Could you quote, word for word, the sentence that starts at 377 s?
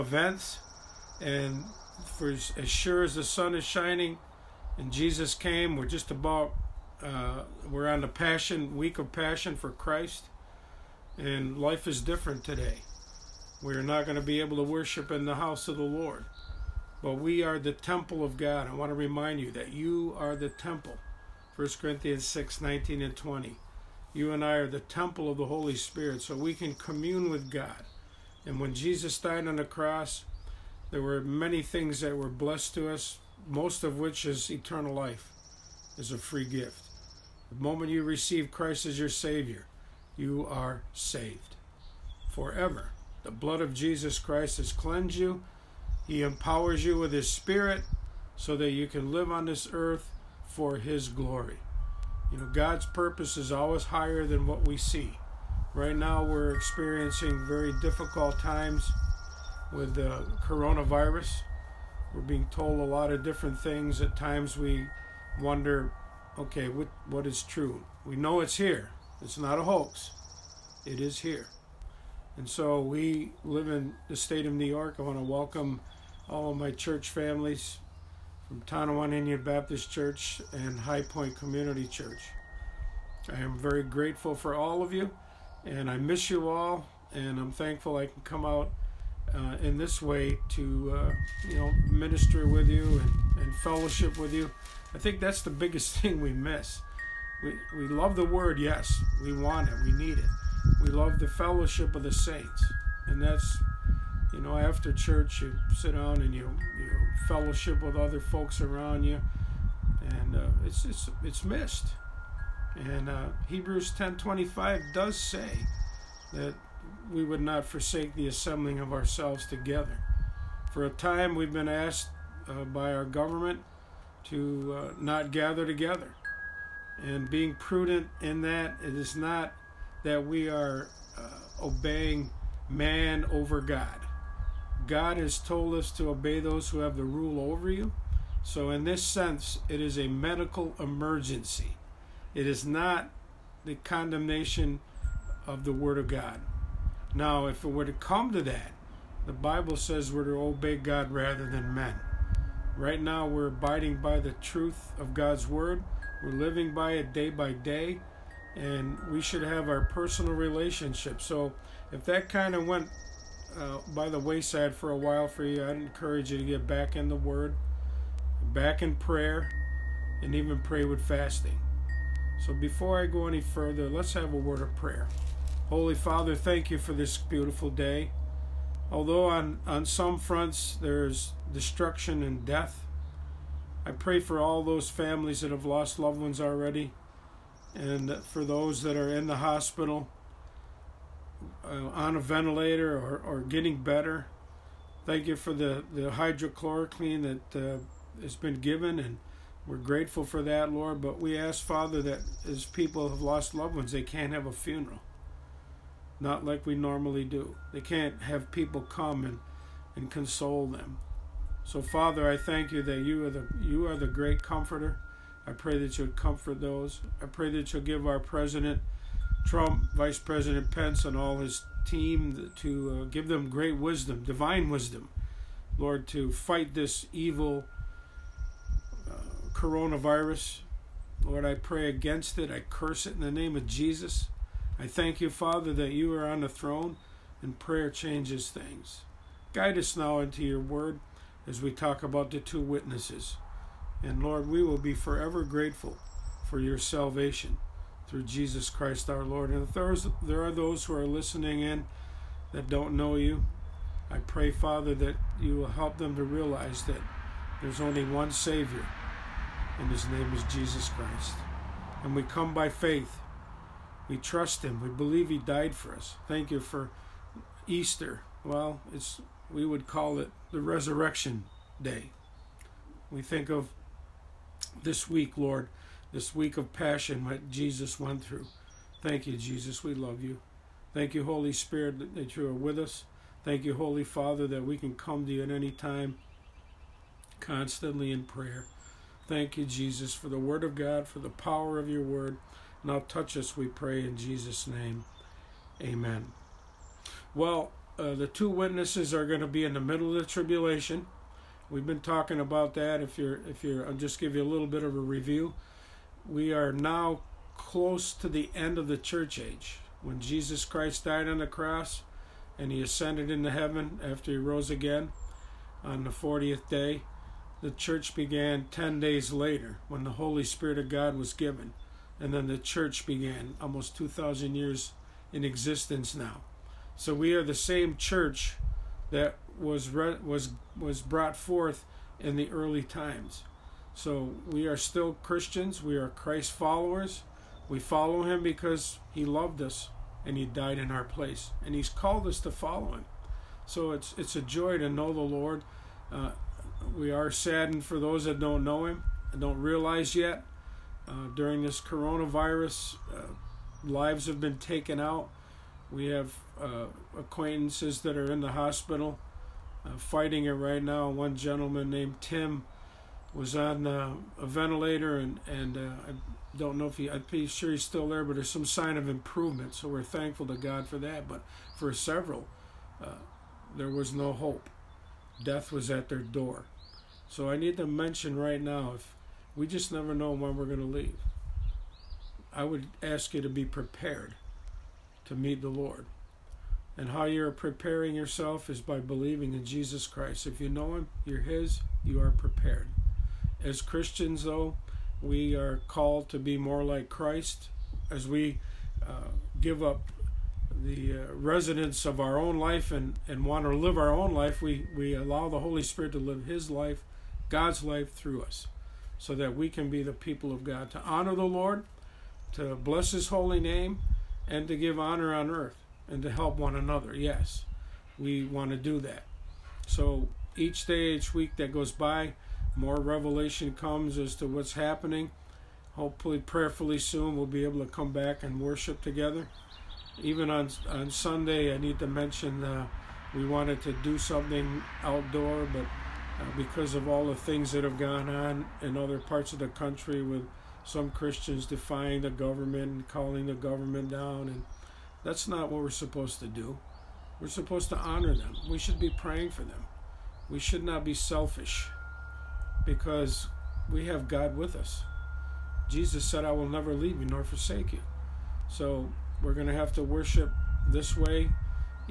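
So I need to mention right now if we just never know when we're going to leave.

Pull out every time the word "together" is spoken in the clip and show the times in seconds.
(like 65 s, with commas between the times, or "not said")
119 s, 125 s, 429 s.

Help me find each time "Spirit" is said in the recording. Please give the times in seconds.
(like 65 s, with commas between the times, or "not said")
25 s, 47 s, 281 s, 320 s, 405 s.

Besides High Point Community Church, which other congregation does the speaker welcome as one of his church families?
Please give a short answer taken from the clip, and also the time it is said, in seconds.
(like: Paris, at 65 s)
Tonawanda Indian Baptist Church, at 78 s.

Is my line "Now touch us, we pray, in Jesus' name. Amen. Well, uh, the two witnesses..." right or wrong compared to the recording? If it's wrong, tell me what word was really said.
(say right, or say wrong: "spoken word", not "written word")
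right.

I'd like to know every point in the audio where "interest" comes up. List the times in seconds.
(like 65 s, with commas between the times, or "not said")
not said.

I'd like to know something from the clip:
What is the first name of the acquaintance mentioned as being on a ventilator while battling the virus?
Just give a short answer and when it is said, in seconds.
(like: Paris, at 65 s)
Tim, at 362 s.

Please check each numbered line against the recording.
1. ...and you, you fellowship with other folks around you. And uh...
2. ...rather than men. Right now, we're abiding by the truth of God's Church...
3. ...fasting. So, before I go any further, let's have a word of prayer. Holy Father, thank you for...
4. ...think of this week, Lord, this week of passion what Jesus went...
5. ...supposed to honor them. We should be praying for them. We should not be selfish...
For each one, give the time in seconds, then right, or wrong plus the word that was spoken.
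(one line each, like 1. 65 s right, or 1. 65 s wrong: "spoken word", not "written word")
1. 106 s right
2. 151 s wrong: "Word", not "Church"
3. 171 s right
4. 273 s right
5. 447 s right.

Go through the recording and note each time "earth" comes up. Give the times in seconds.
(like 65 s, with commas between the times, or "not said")
49 s, 415 s.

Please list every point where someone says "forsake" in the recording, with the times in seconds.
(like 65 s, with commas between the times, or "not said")
117 s, 457 s.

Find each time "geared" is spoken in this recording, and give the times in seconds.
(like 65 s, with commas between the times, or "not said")
not said.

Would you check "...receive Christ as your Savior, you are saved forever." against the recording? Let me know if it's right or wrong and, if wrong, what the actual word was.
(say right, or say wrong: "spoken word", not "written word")
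right.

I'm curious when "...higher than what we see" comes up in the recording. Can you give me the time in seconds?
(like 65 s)
53 s.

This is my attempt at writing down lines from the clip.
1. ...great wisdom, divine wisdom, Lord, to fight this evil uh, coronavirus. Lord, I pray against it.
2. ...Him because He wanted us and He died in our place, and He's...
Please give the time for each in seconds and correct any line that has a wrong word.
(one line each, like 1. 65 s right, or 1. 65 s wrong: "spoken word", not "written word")
1. 223 s right
2. 338 s wrong: "loved", not "wanted".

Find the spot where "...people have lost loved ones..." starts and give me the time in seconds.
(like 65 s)
202 s.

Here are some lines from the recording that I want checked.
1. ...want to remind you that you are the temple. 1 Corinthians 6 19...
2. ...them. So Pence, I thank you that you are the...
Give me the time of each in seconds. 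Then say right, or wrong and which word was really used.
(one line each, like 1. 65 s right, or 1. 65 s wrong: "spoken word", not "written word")
1. 18 s right
2. 210 s wrong: "Father", not "Pence".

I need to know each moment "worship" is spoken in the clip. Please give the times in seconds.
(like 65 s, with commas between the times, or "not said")
14 s, 428 s, 460 s.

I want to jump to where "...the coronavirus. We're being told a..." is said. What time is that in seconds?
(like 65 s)
59 s.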